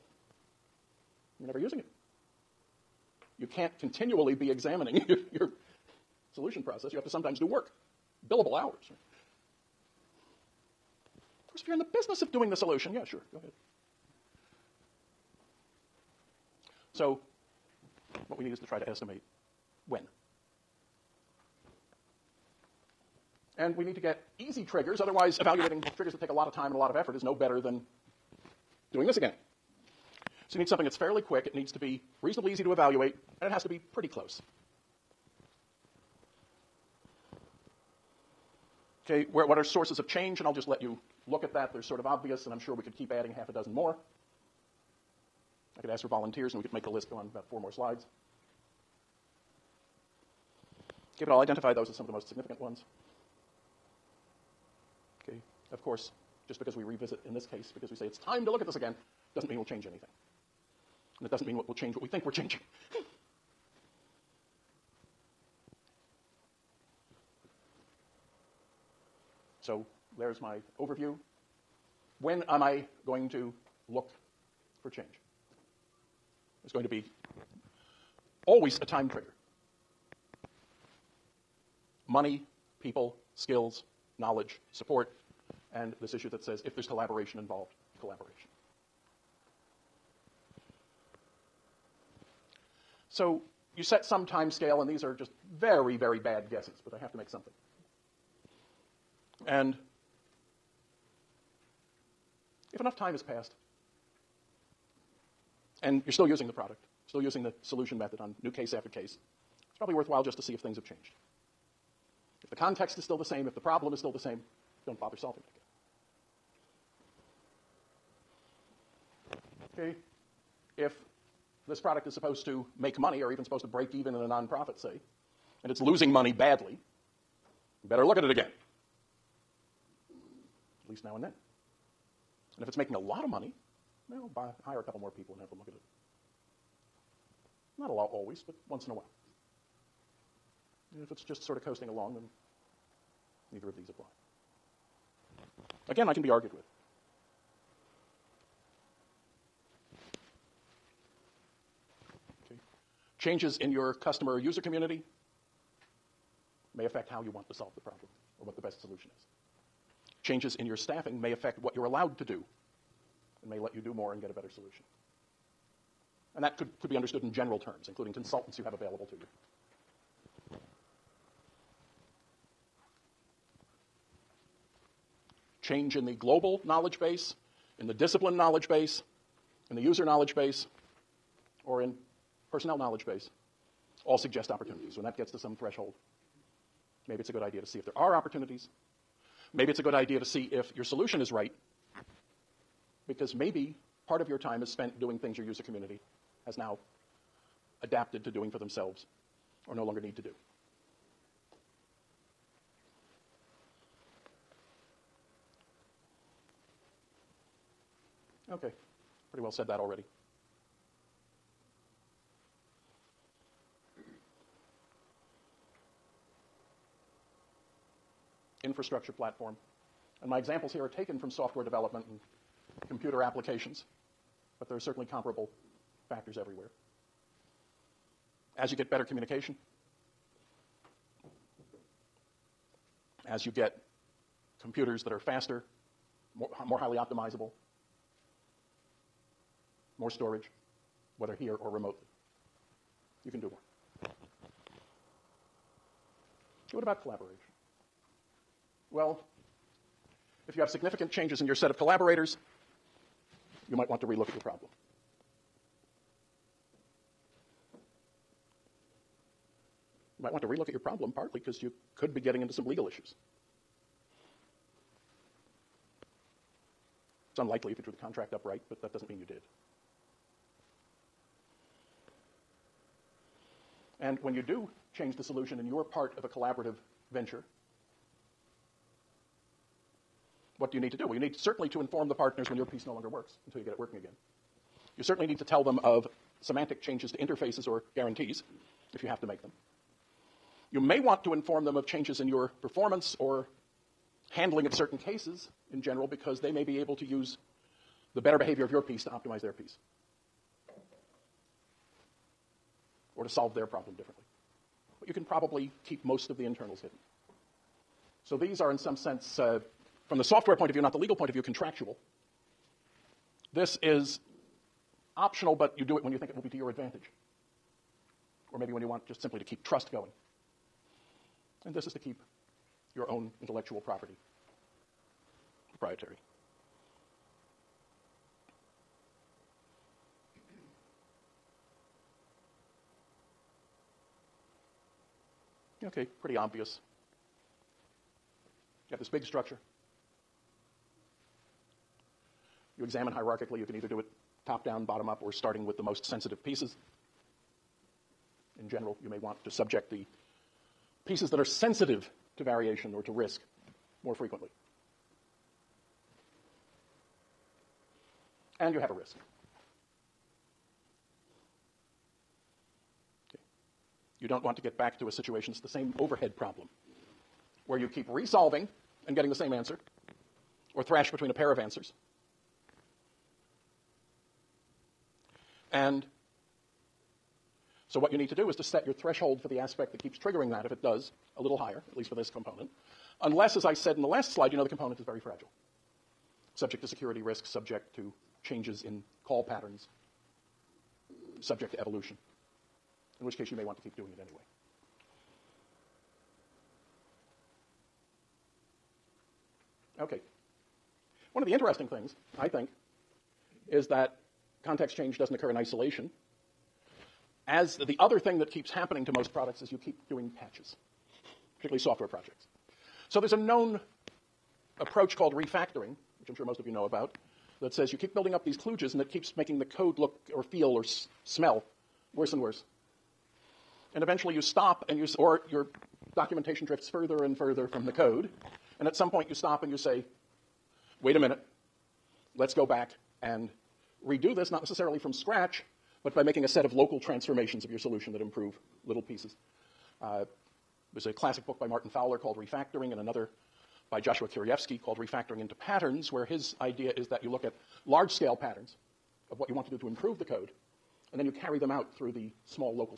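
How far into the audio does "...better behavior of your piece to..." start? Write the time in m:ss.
4:58.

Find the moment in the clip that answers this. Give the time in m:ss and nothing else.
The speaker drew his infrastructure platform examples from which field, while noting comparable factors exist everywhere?
3:41.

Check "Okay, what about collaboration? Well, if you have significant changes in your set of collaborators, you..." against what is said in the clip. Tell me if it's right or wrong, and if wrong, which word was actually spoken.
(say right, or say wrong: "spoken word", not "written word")
right.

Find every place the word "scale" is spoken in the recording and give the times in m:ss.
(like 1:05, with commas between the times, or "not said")
1:34, 7:28.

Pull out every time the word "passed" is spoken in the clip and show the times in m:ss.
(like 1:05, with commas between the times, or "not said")
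1:43.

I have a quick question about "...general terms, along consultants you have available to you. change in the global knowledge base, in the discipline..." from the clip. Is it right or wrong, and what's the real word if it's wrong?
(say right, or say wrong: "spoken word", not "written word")
wrong: "including", not "along".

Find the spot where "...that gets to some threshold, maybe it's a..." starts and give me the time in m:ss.
3:05.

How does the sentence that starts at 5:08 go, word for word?
So these are, in some sense, uh, from the software point of view, not the legal point of view, contractual.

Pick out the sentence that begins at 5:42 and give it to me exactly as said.
you examine hierarchically, you can either do it top down, bottom up, or starting with the most sensitive pieces.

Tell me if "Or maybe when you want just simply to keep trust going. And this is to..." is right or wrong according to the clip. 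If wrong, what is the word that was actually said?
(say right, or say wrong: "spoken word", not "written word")
right.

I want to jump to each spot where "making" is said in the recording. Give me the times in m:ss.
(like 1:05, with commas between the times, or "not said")
2:12, 6:59, 7:16.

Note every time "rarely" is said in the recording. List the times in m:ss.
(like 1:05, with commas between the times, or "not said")
not said.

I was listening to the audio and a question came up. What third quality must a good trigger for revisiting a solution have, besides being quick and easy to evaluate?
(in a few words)
pretty close.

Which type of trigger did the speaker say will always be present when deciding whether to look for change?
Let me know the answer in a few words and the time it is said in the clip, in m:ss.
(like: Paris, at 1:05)
time trigger, at 1:18.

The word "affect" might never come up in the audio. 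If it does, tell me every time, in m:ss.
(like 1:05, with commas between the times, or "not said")
2:36, 2:41.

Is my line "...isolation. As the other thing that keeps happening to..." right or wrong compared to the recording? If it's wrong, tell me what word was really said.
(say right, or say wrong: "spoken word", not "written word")
right.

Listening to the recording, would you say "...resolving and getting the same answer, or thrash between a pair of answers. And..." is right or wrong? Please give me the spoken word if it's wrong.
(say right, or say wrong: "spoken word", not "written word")
right.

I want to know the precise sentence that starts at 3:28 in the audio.
Okay, pretty well said that already.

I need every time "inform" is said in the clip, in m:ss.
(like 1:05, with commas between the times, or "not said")
4:41, 4:51.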